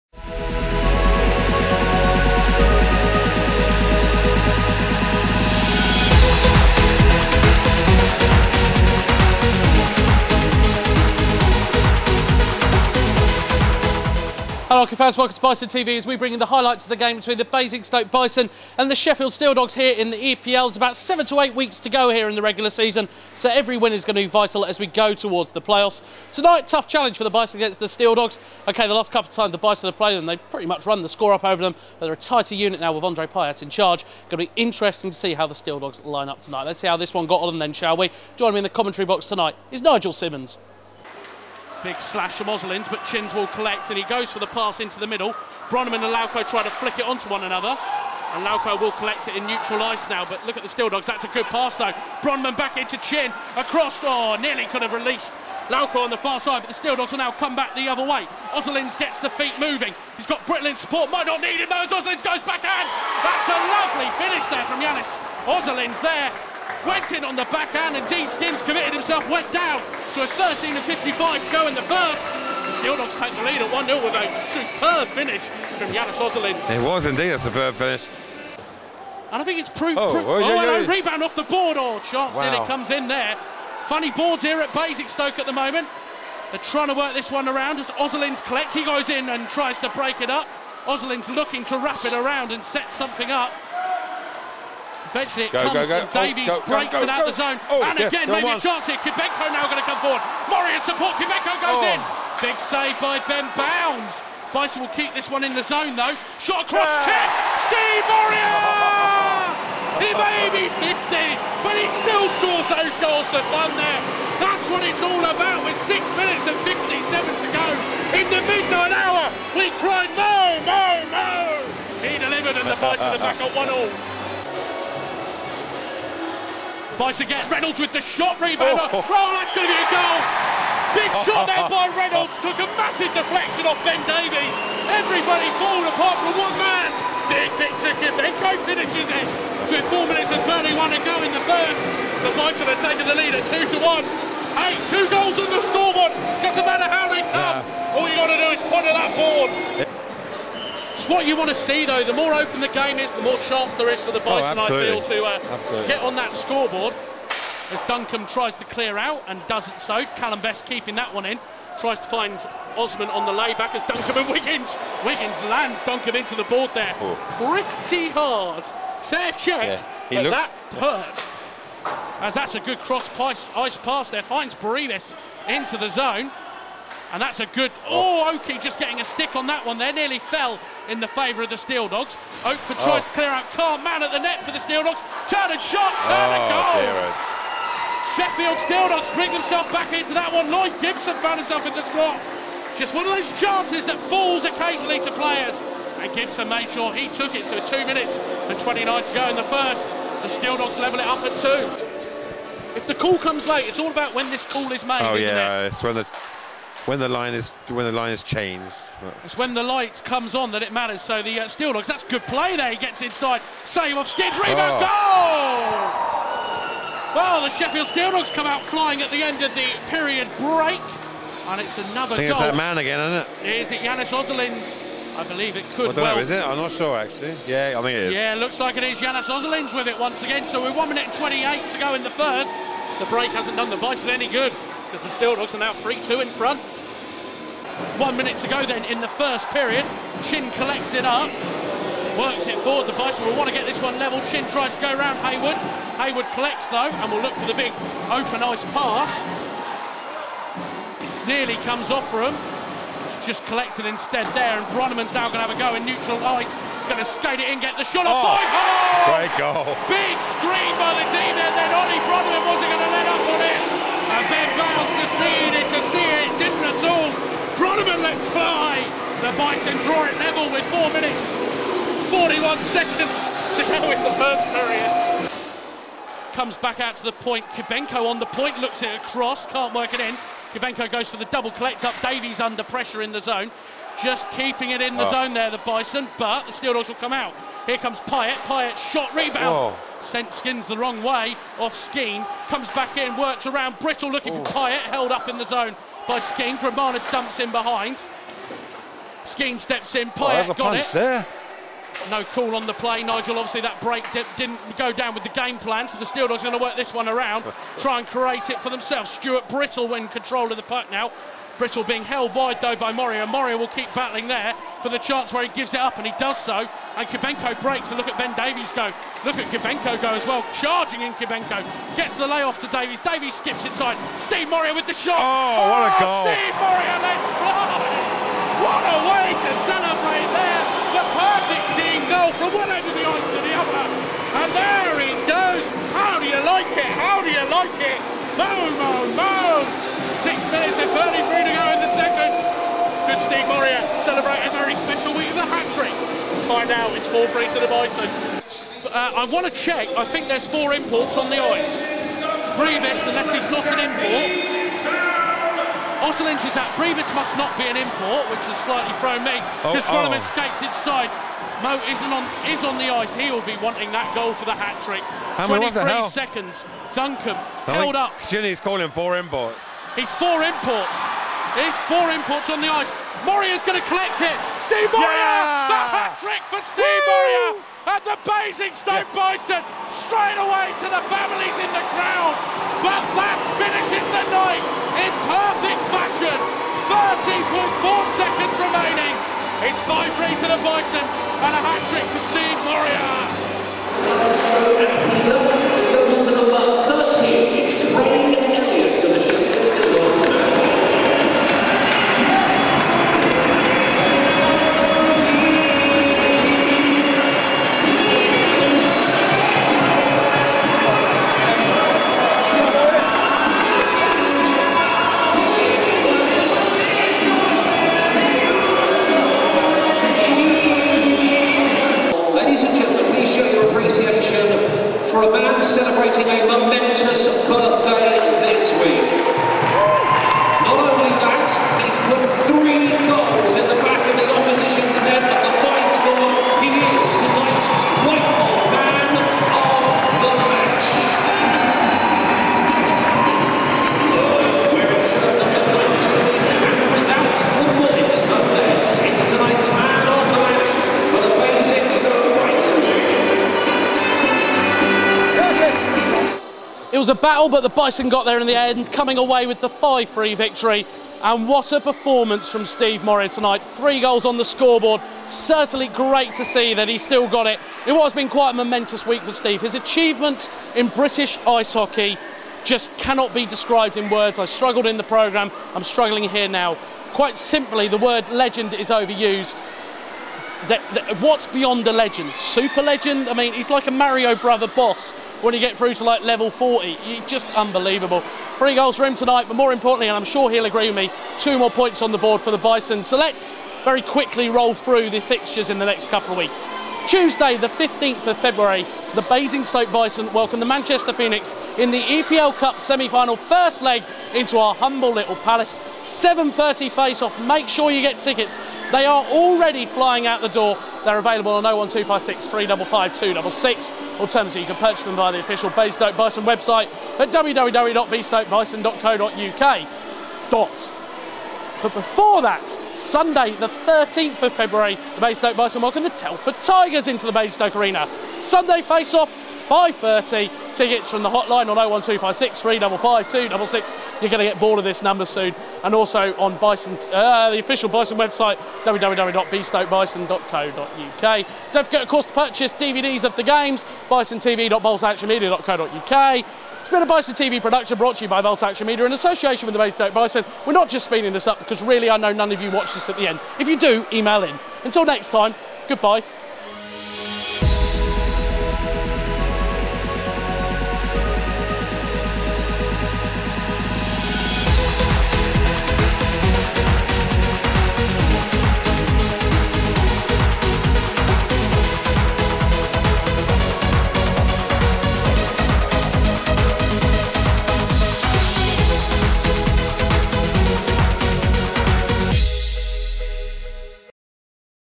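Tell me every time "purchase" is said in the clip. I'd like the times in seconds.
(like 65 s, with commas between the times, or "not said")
514 s, 542 s.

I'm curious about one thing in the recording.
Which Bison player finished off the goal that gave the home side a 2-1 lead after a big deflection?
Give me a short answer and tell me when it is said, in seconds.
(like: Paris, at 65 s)
Victor Kibenko, at 137 s.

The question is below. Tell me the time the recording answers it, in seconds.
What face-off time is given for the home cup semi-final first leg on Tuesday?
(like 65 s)
505 s.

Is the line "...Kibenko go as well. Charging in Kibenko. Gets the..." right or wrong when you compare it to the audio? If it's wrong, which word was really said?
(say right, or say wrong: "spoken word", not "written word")
right.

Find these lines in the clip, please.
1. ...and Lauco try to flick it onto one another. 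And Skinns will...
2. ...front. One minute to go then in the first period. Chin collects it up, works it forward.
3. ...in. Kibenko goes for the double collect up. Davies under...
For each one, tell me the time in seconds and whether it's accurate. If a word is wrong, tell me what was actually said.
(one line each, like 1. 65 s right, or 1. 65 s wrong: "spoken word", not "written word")
1. 46 s wrong: "Lauco", not "Skinns"
2. 236 s right
3. 279 s right.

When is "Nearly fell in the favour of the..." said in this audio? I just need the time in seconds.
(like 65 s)
179 s.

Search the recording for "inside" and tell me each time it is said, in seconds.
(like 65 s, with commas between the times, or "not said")
213 s, 323 s, 360 s.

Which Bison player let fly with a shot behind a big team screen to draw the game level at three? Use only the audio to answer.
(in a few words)
Ollie Bronneman.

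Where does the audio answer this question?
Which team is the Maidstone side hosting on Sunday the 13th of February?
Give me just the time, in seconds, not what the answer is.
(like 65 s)
526 s.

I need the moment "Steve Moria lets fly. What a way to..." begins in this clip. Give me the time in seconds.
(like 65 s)
326 s.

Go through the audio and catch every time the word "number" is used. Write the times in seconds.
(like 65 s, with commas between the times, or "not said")
396 s, 535 s.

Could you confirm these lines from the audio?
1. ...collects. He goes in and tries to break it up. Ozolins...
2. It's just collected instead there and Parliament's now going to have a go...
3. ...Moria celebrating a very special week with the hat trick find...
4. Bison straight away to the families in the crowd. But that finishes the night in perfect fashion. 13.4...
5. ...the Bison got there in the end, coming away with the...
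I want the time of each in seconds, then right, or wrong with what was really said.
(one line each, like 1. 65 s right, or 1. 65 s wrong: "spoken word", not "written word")
1. 88 s right
2. 253 s wrong: "Bronneman", not "Parliament"
3. 343 s right
4. 379 s right
5. 457 s right.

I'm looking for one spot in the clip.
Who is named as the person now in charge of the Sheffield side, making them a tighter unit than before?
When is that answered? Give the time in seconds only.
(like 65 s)
33 s.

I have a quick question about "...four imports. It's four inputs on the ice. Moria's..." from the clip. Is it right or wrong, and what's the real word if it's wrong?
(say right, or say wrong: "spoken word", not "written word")
right.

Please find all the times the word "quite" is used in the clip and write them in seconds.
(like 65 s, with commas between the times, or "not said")
468 s, 477 s.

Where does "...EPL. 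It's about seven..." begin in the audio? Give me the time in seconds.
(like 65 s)
20 s.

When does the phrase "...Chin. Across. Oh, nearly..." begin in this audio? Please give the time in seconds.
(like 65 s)
52 s.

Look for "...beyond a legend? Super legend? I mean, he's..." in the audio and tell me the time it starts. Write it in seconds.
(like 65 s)
481 s.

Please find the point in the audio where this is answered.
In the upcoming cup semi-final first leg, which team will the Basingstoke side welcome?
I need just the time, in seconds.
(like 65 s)
500 s.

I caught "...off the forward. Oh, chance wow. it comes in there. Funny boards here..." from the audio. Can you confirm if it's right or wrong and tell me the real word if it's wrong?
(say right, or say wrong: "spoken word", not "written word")
wrong: "board", not "forward".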